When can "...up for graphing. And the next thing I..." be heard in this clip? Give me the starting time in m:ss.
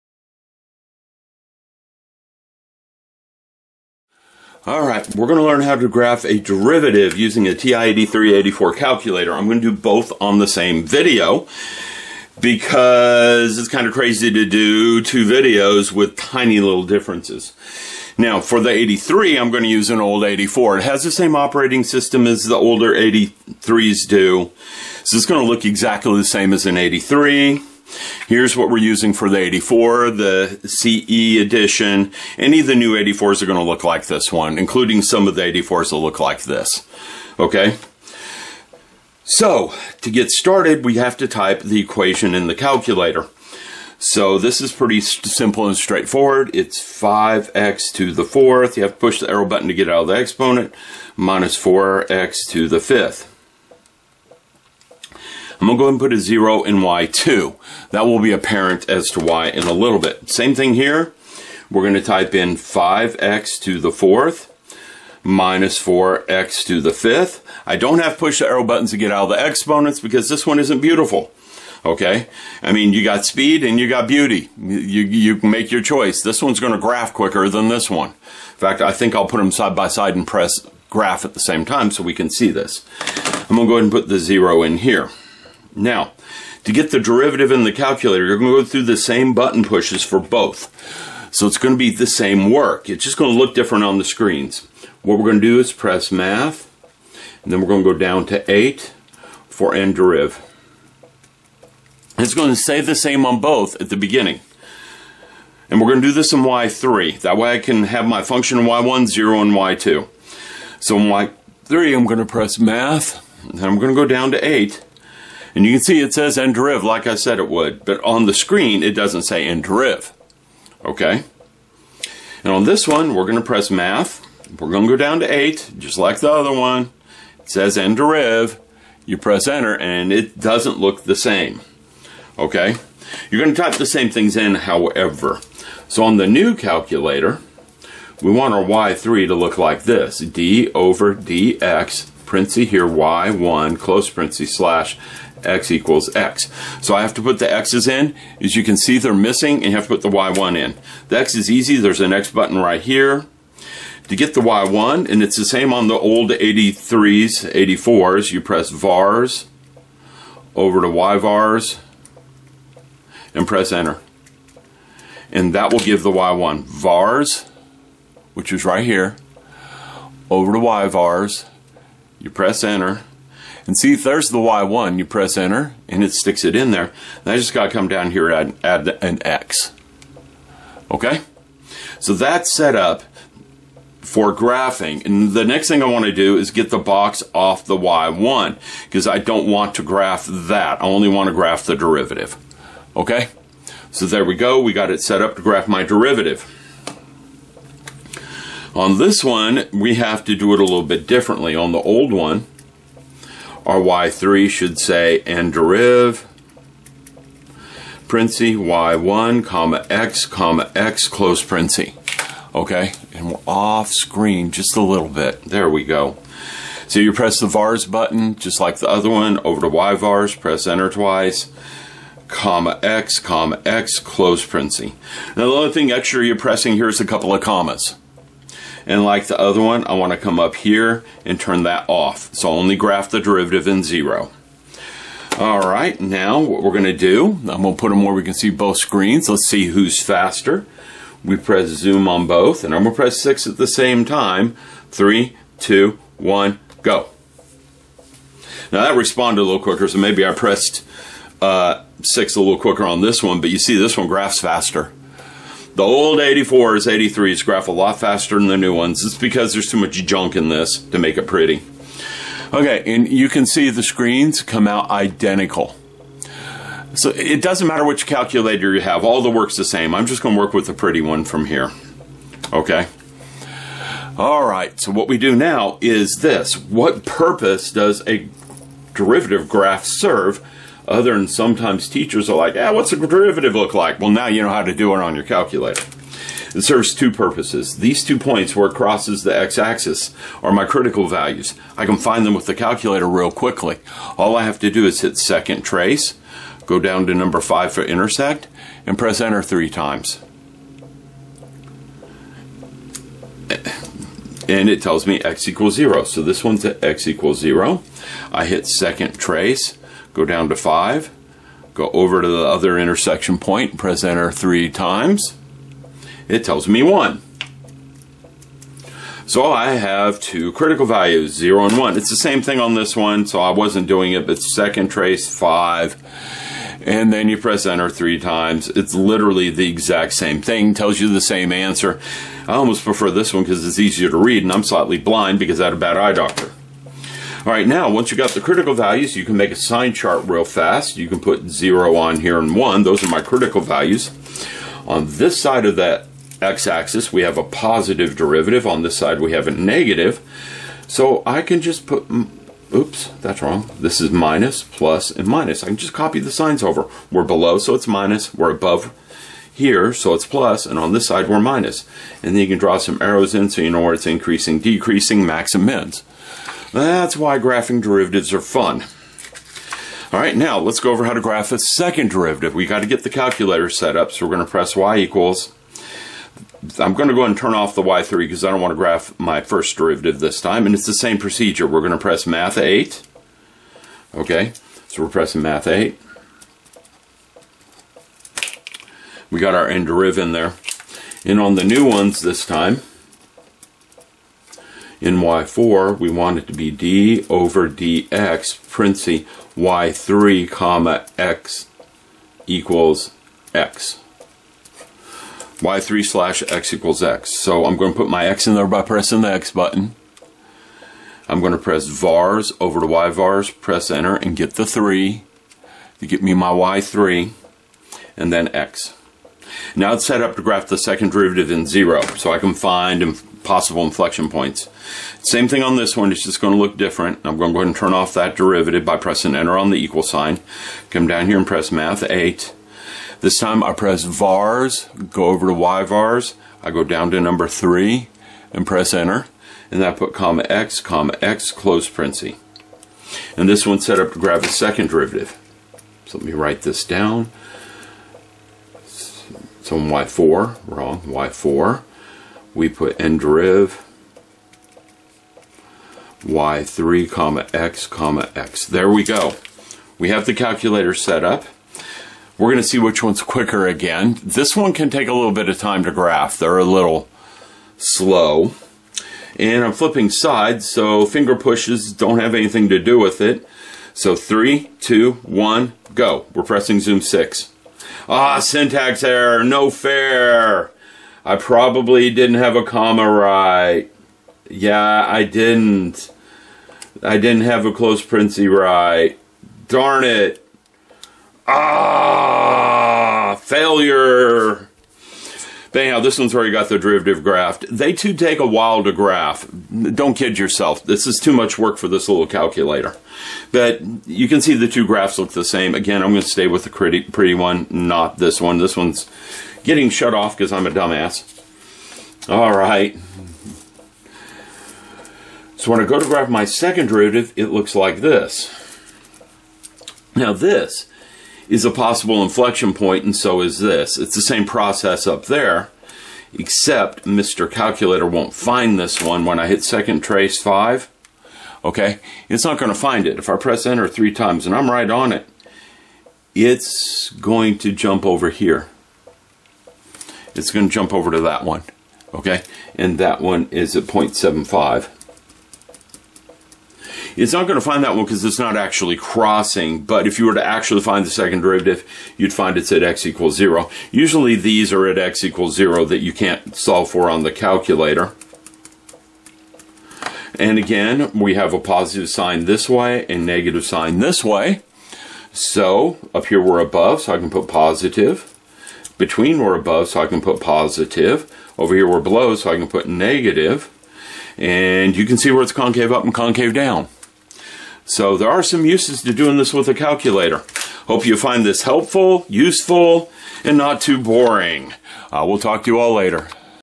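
3:02.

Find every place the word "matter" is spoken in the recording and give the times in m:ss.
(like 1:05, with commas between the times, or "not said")
4:27.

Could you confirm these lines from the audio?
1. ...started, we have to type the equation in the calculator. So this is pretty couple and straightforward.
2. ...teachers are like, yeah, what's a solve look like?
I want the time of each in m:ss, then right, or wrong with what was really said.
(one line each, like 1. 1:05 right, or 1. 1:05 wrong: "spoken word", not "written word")
1. 0:40 wrong: "simple", not "couple"
2. 4:41 wrong: "derivative", not "solve".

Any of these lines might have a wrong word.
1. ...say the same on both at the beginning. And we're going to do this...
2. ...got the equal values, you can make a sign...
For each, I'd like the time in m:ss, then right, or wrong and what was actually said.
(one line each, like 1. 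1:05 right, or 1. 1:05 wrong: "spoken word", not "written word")
1. 1:42 right
2. 5:38 wrong: "critical", not "equal".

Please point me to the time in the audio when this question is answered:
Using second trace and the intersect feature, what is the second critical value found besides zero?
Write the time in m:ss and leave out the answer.
5:16.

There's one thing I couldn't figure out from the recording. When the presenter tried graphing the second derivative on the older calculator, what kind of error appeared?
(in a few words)
syntax error.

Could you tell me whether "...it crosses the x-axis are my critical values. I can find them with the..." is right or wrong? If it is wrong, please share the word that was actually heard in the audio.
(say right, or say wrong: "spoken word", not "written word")
right.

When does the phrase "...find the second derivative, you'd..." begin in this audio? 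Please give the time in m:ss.
9:10.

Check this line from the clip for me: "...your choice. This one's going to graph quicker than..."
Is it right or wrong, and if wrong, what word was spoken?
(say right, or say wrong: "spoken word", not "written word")
right.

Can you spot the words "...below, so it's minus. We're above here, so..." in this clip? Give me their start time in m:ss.
5:57.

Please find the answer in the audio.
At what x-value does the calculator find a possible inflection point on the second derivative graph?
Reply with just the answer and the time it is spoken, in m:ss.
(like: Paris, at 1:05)
0.75, at 9:03.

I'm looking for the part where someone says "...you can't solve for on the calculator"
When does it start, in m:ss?
9:15.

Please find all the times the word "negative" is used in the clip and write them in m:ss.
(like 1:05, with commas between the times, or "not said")
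5:49, 9:23, 9:32.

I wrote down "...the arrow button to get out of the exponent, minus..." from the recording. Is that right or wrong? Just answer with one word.
right.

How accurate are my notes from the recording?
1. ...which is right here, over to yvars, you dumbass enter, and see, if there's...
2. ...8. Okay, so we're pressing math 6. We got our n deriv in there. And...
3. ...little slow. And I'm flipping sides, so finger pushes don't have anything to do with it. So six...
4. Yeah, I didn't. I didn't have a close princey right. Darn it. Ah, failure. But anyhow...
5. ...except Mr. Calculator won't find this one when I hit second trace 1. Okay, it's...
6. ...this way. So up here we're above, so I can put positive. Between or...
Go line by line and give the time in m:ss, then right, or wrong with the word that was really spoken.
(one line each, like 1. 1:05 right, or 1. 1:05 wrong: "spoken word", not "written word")
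1. 2:48 wrong: "press", not "dumbass"
2. 6:22 wrong: "8", not "6"
3. 7:46 wrong: "three", not "six"
4. 8:04 right
5. 8:46 wrong: "5", not "1"
6. 9:23 right.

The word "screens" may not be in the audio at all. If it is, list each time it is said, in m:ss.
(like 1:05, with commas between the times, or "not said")
1:34, 1:58, 3:33, 3:58, 4:23.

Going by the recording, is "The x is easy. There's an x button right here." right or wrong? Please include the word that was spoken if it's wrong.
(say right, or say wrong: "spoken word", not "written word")
right.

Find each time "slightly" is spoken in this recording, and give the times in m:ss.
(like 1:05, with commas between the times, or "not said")
5:34.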